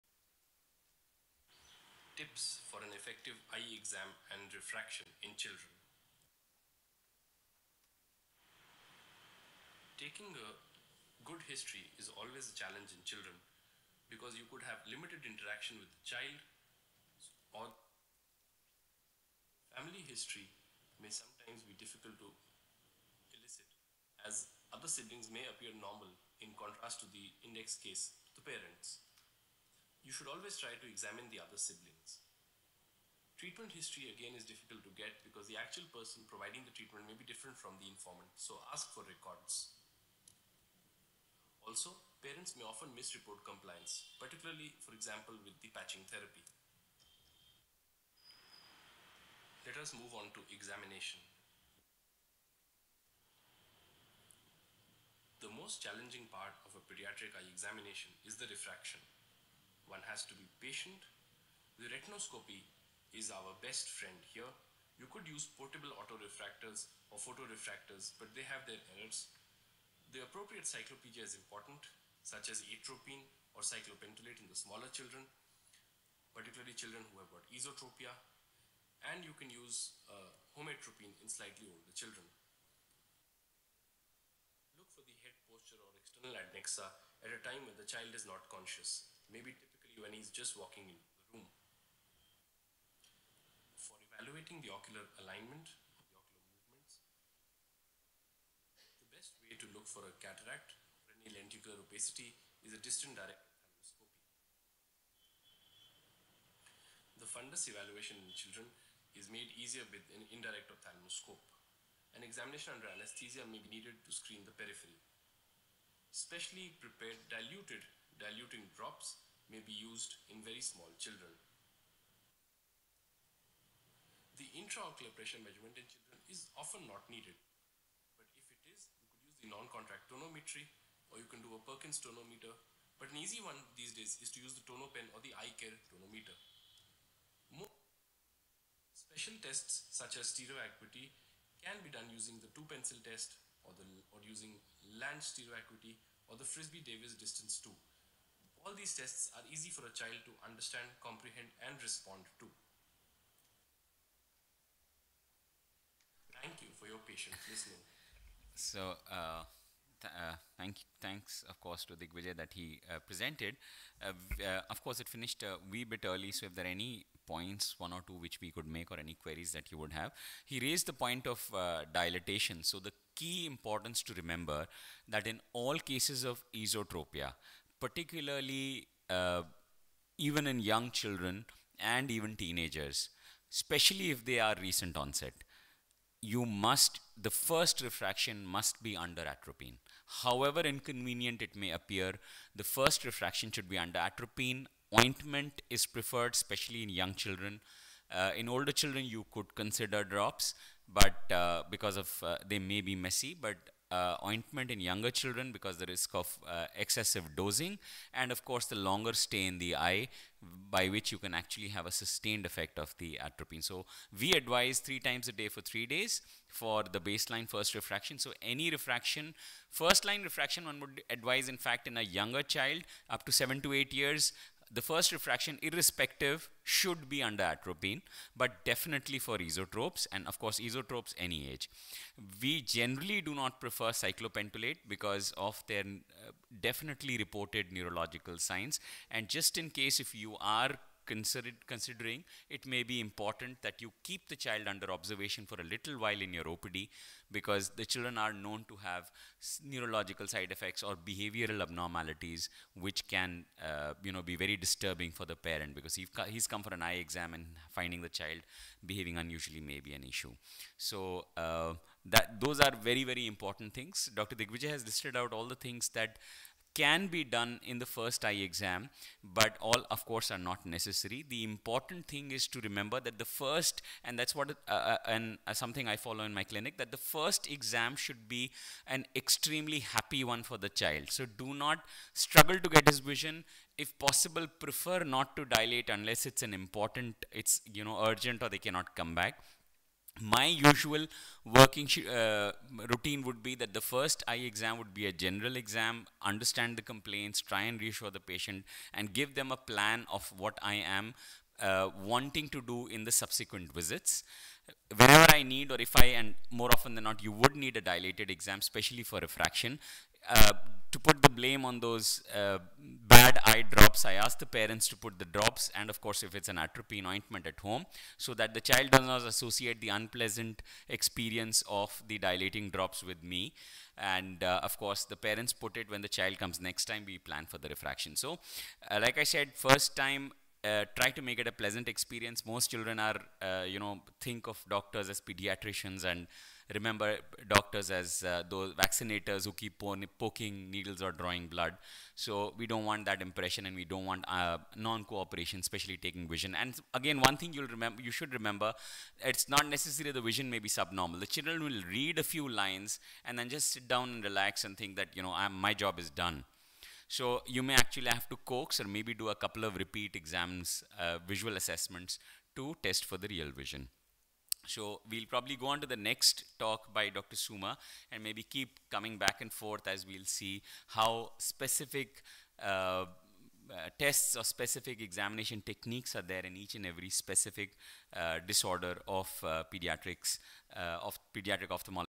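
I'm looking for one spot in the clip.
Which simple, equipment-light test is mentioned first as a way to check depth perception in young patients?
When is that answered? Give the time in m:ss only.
2:22.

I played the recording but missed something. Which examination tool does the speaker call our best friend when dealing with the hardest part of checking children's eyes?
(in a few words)
Retinoscopy.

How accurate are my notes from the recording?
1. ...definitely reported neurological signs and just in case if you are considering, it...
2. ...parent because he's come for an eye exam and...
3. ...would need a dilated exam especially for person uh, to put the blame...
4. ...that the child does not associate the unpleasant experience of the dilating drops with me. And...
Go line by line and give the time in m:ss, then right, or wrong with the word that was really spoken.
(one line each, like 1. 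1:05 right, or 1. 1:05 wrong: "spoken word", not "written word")
1. 3:56 right
2. 4:15 right
3. 5:07 wrong: "refraction", not "person"
4. 5:18 right.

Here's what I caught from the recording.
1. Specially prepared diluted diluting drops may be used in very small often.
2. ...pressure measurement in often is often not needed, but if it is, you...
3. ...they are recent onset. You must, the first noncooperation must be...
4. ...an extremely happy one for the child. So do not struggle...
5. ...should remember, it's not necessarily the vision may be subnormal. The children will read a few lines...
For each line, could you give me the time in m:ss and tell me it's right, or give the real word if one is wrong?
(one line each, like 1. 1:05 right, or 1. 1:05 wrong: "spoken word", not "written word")
1. 1:56 wrong: "children", not "often"
2. 2:05 wrong: "children", not "often"
3. 3:04 wrong: "refraction", not "noncooperation"
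4. 4:38 right
5. 5:48 right.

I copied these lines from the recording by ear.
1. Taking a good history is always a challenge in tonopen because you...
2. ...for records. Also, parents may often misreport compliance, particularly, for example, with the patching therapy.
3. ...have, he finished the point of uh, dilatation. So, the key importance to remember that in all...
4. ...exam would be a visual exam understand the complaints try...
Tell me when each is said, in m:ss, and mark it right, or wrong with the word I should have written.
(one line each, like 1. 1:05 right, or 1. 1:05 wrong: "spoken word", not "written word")
1. 0:09 wrong: "children", not "tonopen"
2. 0:38 right
3. 2:49 wrong: "raised", not "finished"
4. 4:54 wrong: "general", not "visual".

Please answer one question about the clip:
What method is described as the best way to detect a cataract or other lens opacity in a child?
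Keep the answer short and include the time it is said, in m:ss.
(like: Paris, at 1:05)
Distant direct ophthalmoscopy, at 1:42.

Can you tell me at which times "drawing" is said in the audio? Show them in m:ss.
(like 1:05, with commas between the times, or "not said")
5:41.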